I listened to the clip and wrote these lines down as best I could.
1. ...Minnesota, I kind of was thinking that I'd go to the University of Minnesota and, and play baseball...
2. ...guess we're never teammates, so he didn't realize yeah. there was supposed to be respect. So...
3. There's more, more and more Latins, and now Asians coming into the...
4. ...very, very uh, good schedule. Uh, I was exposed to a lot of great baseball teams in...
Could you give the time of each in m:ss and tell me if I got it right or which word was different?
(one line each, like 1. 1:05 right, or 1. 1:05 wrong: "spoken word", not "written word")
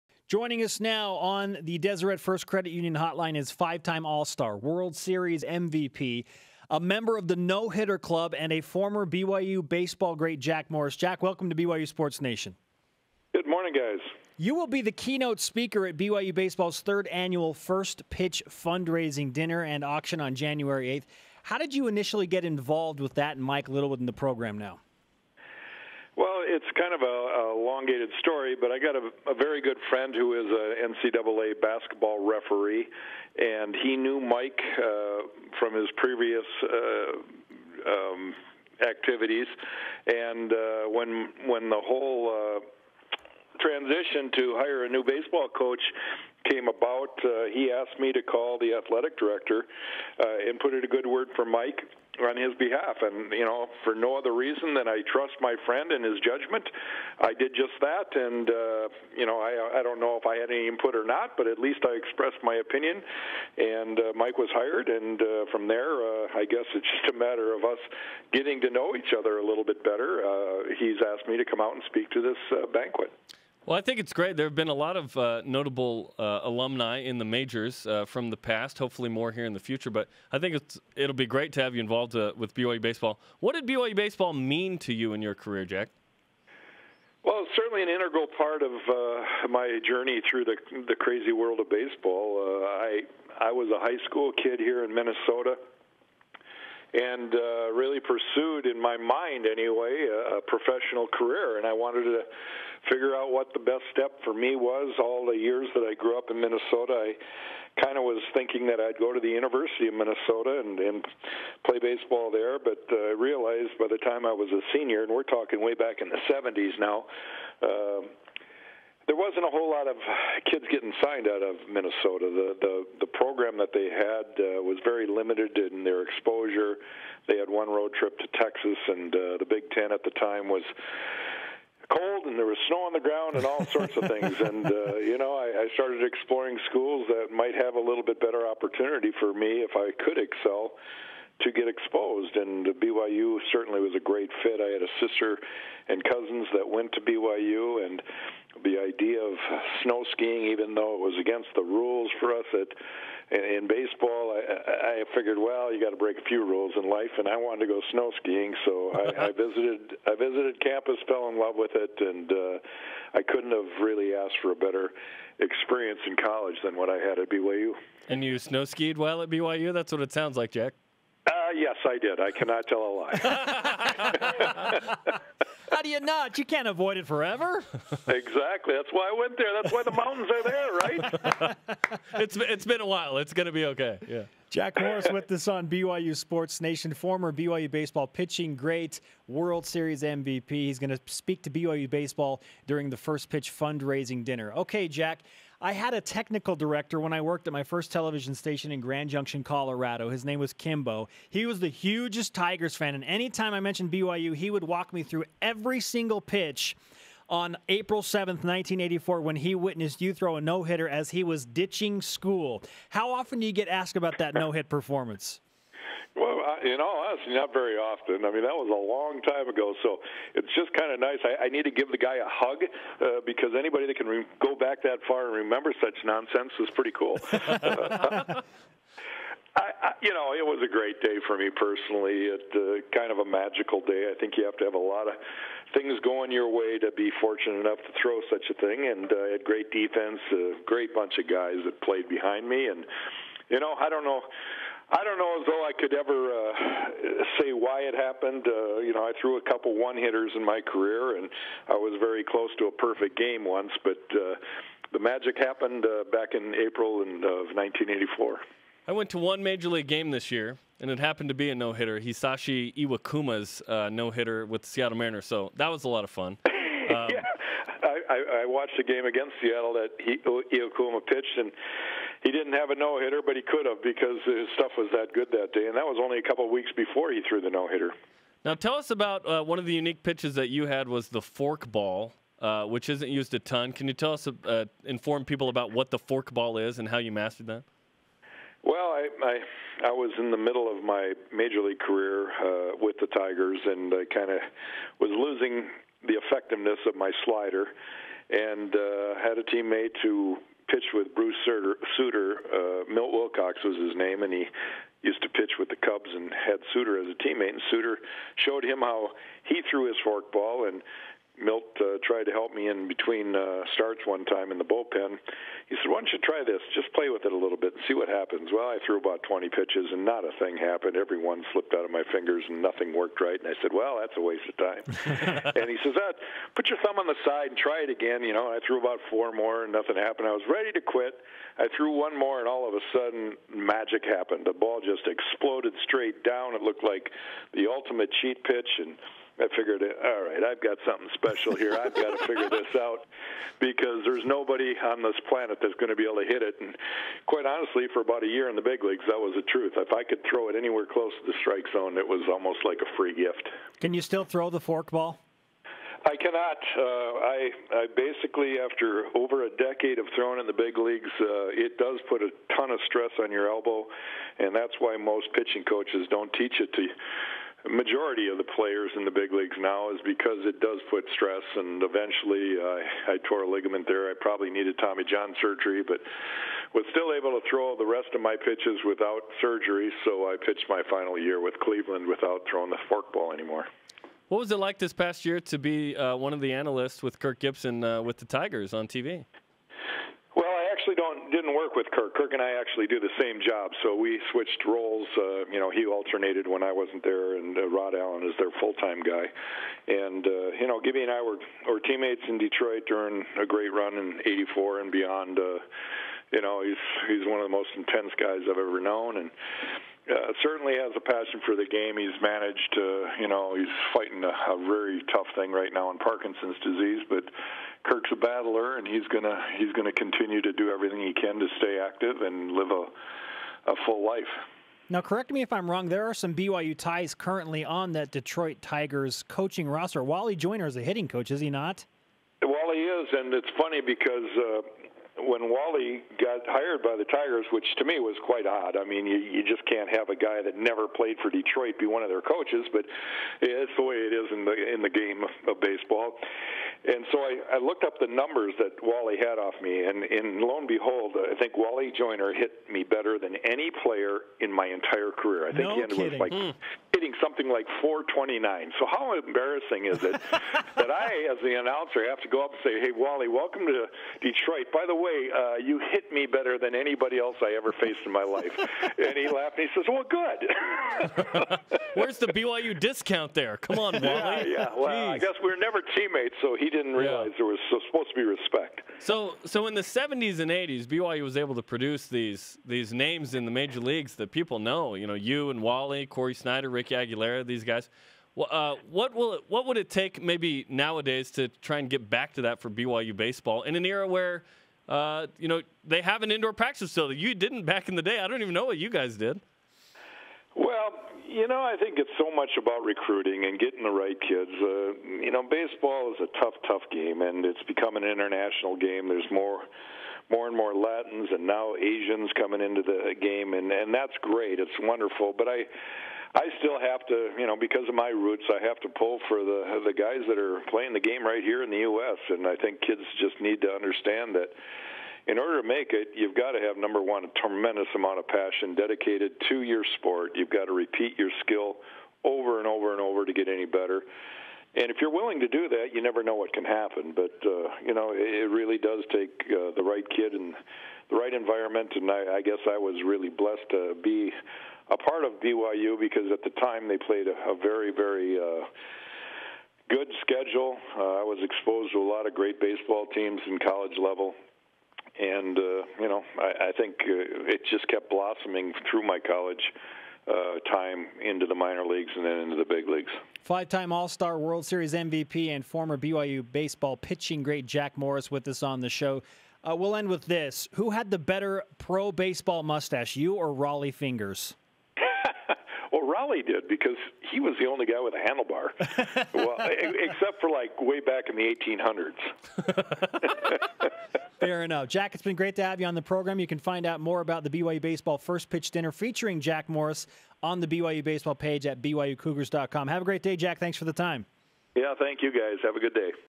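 1. 1:46 right
2. 7:55 right
3. 8:29 right
4. 9:07 right.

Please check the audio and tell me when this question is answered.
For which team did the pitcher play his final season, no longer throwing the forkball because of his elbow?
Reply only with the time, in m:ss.
6:21.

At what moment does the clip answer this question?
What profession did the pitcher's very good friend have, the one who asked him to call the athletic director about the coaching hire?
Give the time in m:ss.
0:30.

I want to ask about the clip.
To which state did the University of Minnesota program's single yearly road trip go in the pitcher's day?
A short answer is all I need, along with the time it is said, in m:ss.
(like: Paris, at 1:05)
Texas, at 2:08.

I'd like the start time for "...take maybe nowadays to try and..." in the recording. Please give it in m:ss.
8:09.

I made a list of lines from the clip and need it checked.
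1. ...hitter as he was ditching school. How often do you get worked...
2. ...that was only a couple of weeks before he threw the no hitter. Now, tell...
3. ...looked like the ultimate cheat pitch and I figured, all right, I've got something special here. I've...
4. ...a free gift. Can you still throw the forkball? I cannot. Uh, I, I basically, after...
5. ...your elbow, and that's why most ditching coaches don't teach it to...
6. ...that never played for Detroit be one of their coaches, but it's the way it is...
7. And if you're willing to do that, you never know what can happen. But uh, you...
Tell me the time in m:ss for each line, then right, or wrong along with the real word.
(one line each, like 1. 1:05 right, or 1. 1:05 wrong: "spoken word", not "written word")
1. 3:30 wrong: "asked", not "worked"
2. 4:35 right
3. 5:36 right
4. 5:52 right
5. 6:03 wrong: "pitching", not "ditching"
6. 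7:20 right
7. 8:54 right.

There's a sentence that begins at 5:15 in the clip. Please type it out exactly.
He said, "Why don't you try this?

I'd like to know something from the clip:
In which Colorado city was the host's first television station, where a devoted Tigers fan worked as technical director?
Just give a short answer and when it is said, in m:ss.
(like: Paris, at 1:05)
Grand Junction, at 3:18.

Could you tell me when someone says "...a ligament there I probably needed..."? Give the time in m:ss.
6:13.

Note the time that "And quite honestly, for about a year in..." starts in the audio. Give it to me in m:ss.
5:46.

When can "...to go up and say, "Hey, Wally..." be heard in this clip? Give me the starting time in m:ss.
7:42.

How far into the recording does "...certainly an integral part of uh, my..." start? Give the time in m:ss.
1:27.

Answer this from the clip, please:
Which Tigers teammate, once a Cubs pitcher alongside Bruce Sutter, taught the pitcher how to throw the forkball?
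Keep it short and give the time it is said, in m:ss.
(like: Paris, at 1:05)
Milt Wilcox, at 5:02.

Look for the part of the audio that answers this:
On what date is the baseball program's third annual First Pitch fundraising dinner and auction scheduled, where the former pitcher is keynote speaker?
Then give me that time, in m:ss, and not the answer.
0:20.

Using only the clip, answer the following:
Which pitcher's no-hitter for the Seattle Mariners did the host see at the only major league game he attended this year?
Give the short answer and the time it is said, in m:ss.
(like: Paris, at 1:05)
Hisashi Iwakuma, at 4:21.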